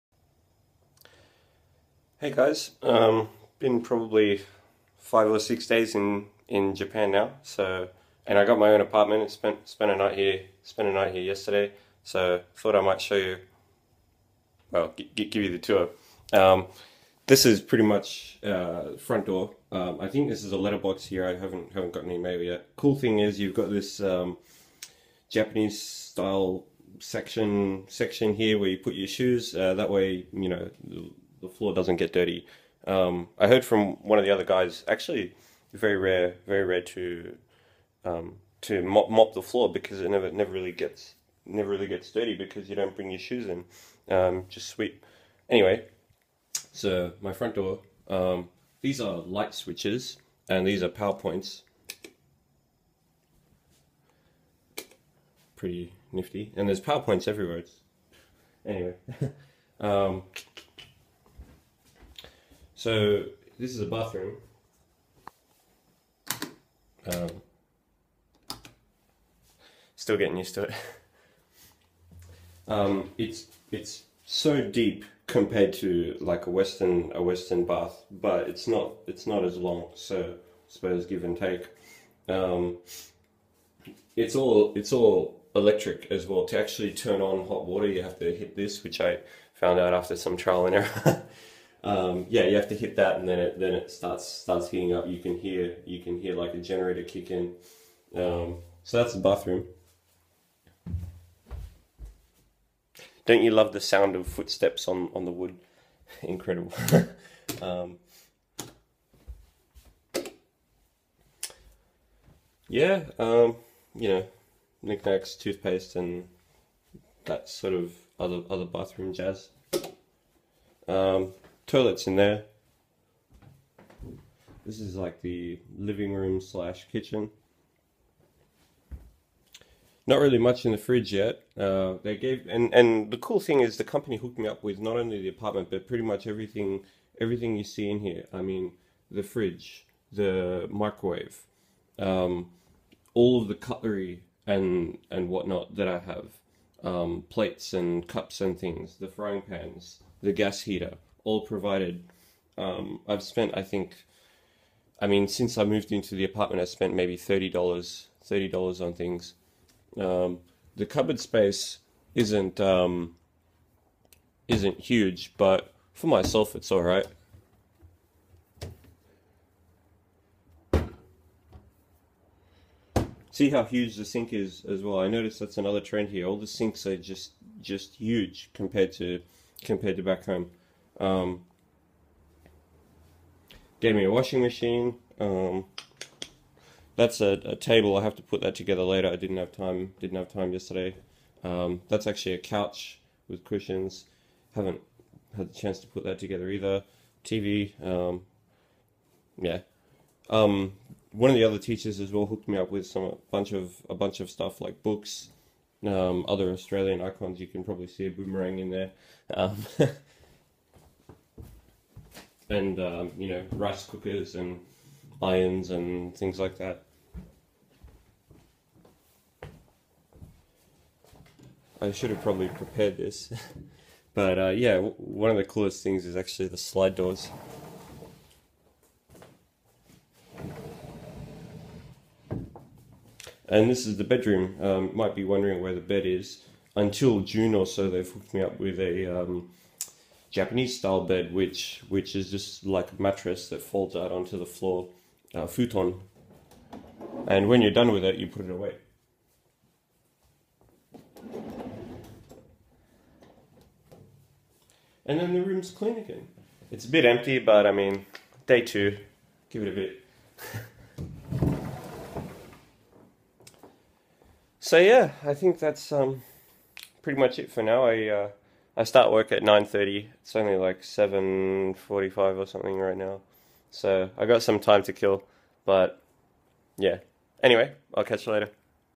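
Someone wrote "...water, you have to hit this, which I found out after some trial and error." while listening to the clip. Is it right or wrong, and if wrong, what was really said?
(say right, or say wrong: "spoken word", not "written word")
right.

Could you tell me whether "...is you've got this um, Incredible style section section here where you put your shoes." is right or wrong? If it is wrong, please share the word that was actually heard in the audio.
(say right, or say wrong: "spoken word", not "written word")
wrong: "Japanese", not "Incredible".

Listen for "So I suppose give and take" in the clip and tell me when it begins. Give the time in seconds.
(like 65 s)
79 s.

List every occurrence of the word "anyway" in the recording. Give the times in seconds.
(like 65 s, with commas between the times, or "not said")
45 s, 58 s, 277 s.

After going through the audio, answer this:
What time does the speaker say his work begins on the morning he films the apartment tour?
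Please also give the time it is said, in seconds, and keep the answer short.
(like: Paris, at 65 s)
9:30, at 269 s.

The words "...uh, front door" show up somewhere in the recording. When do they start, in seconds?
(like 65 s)
18 s.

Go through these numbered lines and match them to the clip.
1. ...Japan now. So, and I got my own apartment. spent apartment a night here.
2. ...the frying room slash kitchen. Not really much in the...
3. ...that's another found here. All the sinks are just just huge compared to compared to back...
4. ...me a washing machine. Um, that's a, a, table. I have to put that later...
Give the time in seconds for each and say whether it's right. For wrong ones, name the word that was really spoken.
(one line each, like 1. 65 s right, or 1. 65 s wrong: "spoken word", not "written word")
1. 6 s wrong: "spent", not "apartment"
2. 125 s wrong: "living", not "frying"
3. 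175 s wrong: "trend", not "found"
4. 183 s wrong: "together", not "later".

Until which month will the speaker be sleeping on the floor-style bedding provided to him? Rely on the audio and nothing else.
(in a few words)
June.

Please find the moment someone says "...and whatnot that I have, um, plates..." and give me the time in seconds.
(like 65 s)
145 s.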